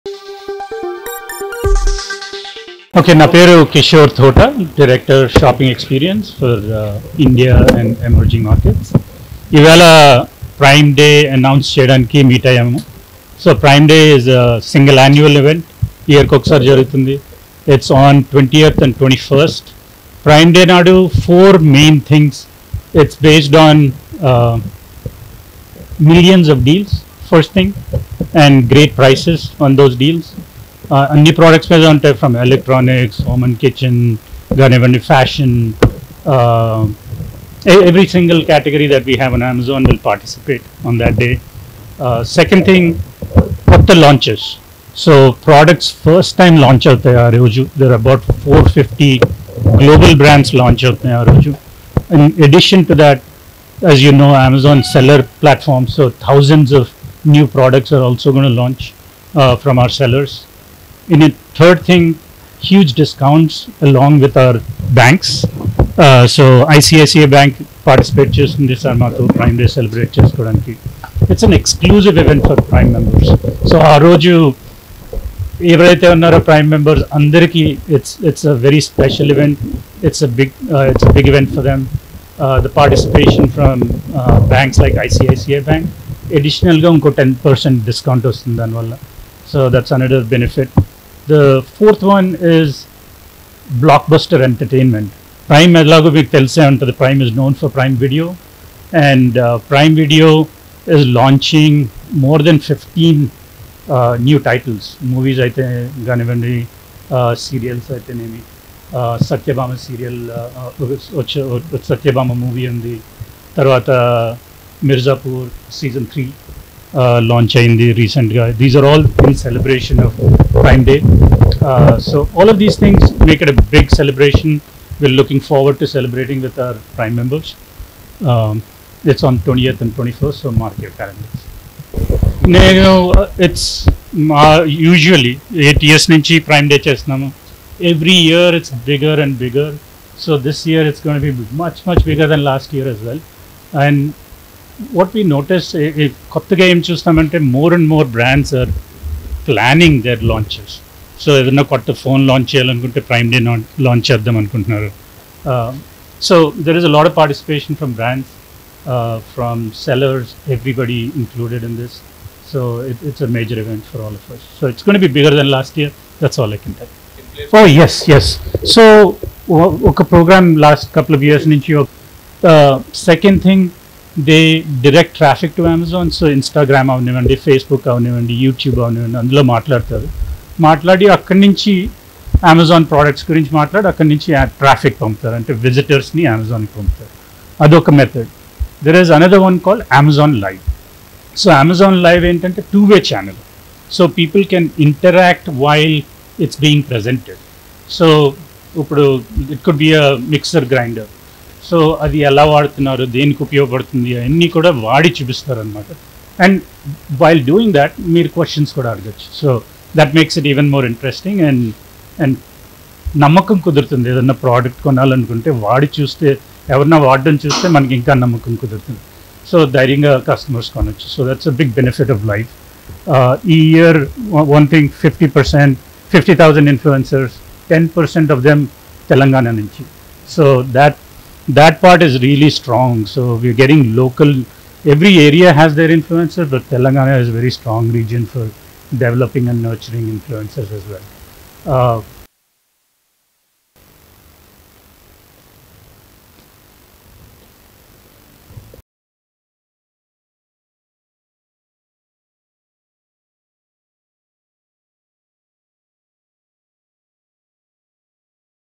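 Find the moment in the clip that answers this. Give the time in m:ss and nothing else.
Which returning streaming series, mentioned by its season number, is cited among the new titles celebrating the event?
1:54.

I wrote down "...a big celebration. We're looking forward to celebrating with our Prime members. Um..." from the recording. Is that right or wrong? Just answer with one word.
right.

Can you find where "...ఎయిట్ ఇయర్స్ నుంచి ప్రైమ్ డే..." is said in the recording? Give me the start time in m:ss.
2:15.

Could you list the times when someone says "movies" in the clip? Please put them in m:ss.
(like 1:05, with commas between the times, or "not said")
1:45, 1:52.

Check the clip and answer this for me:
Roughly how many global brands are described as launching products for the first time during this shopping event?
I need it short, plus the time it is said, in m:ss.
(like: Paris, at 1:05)
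450, at 0:48.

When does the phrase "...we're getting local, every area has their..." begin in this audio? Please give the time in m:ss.
3:53.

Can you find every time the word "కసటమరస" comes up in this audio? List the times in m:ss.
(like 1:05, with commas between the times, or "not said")
3:40.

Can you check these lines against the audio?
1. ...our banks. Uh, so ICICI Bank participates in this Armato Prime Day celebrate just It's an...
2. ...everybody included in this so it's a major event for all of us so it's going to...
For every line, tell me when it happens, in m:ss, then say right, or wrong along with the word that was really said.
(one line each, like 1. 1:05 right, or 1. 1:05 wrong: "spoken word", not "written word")
1. 1:04 right
2. 2:40 right.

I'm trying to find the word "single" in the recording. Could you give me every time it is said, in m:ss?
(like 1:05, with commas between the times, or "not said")
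0:14, 0:38.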